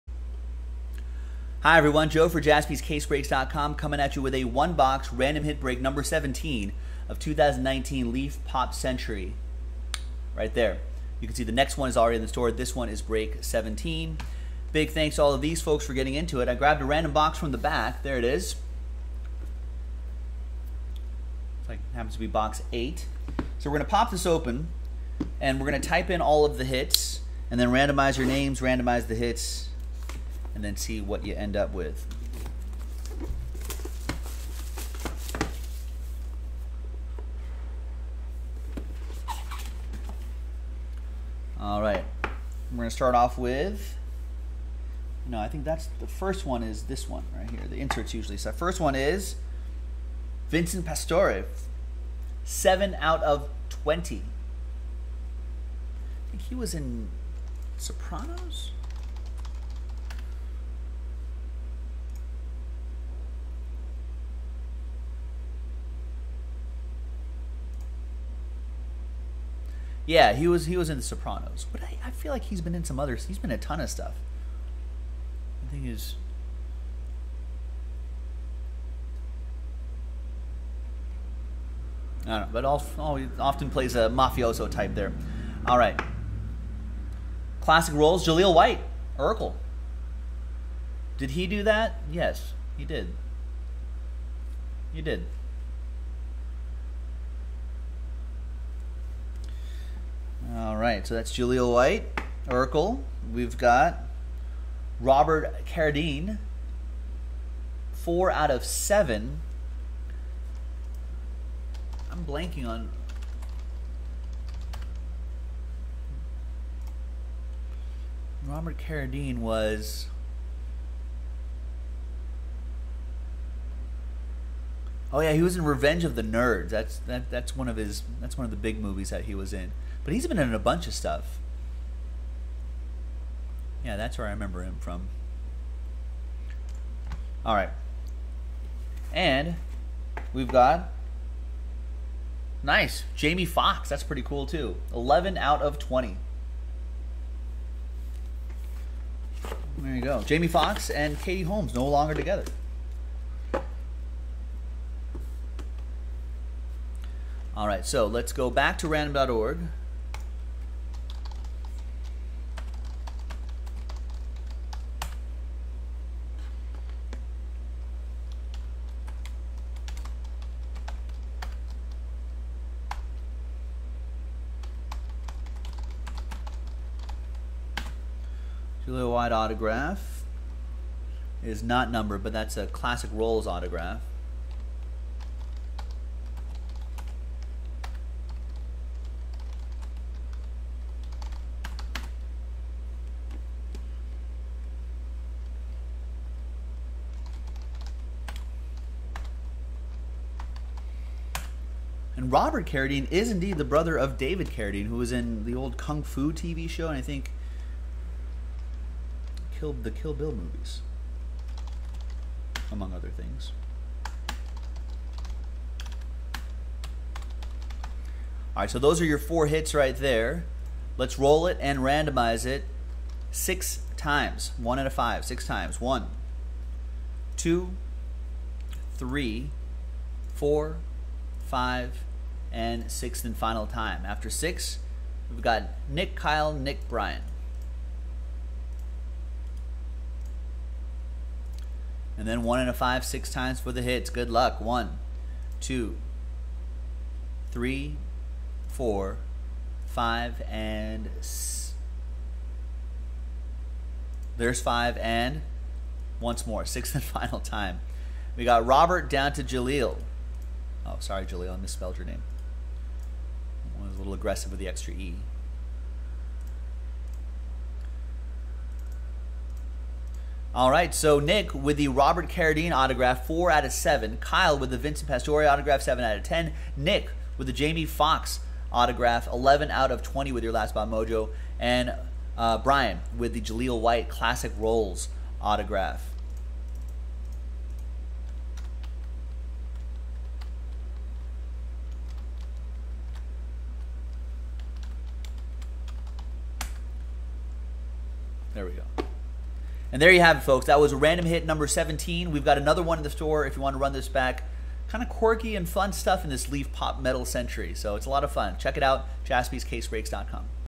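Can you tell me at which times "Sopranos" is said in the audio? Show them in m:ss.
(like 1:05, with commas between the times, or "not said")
0:57, 1:11.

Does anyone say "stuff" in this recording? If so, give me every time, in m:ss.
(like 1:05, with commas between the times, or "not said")
1:13, 2:10, 5:05.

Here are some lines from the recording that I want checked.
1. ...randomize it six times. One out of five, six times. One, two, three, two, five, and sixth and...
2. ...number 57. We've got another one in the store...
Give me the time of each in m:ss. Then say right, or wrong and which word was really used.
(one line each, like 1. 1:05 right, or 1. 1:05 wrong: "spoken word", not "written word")
1. 3:41 wrong: "four", not "two"
2. 5:01 wrong: "17", not "57".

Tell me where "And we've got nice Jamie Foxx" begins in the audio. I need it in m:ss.
2:19.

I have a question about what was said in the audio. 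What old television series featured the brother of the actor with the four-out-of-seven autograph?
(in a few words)
Kung Fu.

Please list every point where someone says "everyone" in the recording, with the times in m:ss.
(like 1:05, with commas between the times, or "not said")
0:01.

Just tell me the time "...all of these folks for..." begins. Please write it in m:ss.
0:15.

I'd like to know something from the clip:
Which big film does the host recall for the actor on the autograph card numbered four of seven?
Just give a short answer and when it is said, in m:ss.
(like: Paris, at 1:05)
Revenge of the Nerds, at 2:05.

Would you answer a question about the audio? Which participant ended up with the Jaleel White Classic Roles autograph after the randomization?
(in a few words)
Brian.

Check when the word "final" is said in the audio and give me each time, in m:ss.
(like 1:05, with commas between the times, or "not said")
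3:53, 4:17.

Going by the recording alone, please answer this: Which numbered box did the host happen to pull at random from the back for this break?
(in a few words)
8.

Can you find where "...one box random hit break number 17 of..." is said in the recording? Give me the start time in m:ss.
0:04.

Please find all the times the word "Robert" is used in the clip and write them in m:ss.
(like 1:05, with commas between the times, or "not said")
1:44, 1:58, 3:22, 4:18, 4:31.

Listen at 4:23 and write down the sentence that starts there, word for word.
I was a little aggressive with the extra E.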